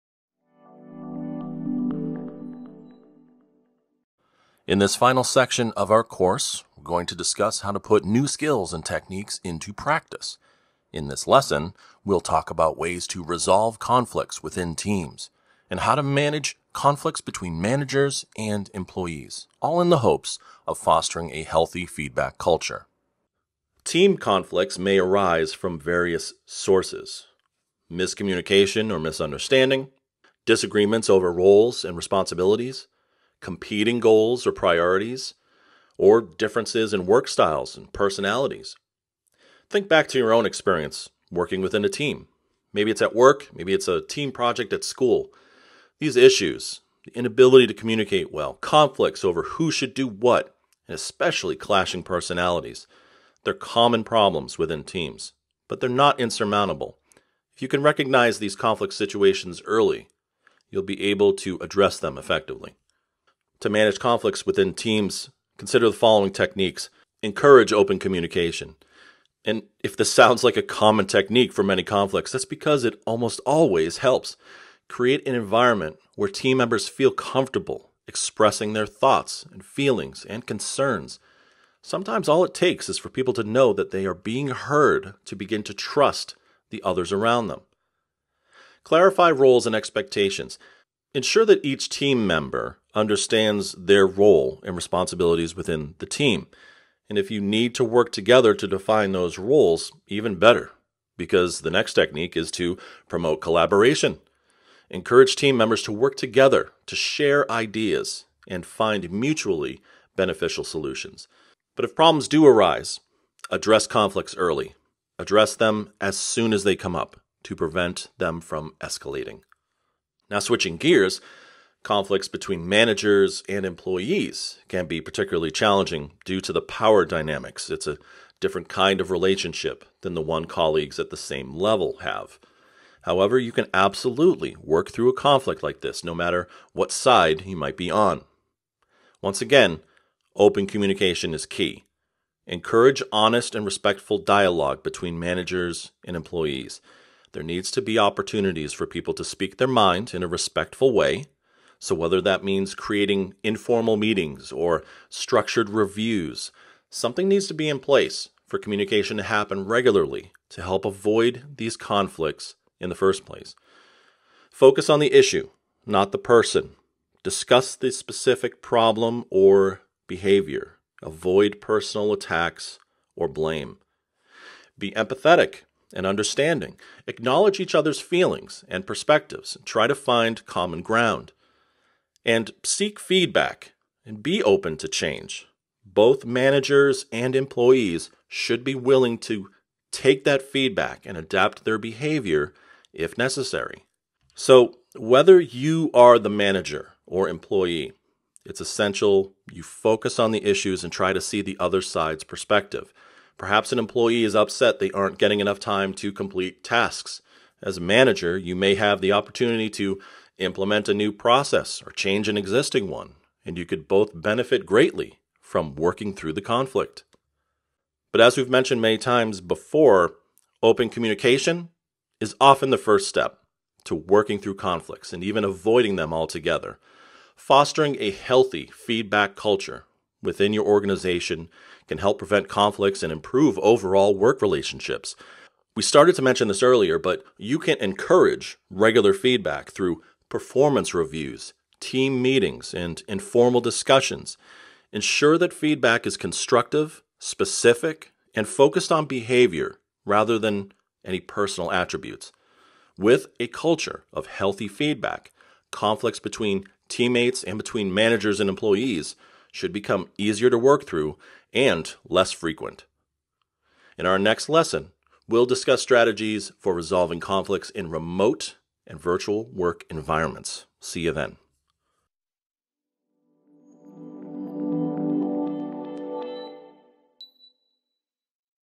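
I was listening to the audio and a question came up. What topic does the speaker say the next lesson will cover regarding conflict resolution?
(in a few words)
Remote and virtual work environments.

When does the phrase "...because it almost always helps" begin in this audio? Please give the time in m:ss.
1:12.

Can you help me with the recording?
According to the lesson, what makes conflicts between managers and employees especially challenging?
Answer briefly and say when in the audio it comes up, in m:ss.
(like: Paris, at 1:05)
Power dynamics, at 2:06.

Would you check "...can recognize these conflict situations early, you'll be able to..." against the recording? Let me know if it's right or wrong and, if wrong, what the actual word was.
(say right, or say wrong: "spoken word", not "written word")
right.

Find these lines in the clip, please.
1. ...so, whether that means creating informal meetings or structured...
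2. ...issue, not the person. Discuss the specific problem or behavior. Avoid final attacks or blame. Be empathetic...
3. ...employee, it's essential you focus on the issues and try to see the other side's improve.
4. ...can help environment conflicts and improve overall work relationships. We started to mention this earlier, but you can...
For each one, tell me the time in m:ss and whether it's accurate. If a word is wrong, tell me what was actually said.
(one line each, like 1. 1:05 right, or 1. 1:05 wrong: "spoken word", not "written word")
1. 2:31 right
2. 2:45 wrong: "personal", not "final"
3. 3:17 wrong: "perspective", not "improve"
4. 3:51 wrong: "prevent", not "environment".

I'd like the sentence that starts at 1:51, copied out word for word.
But if problems do arise, address conflicts early.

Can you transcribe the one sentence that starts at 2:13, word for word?
However, you can absolutely work through a conflict like this, no matter what side you might be on.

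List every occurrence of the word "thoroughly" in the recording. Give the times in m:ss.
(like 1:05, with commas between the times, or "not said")
not said.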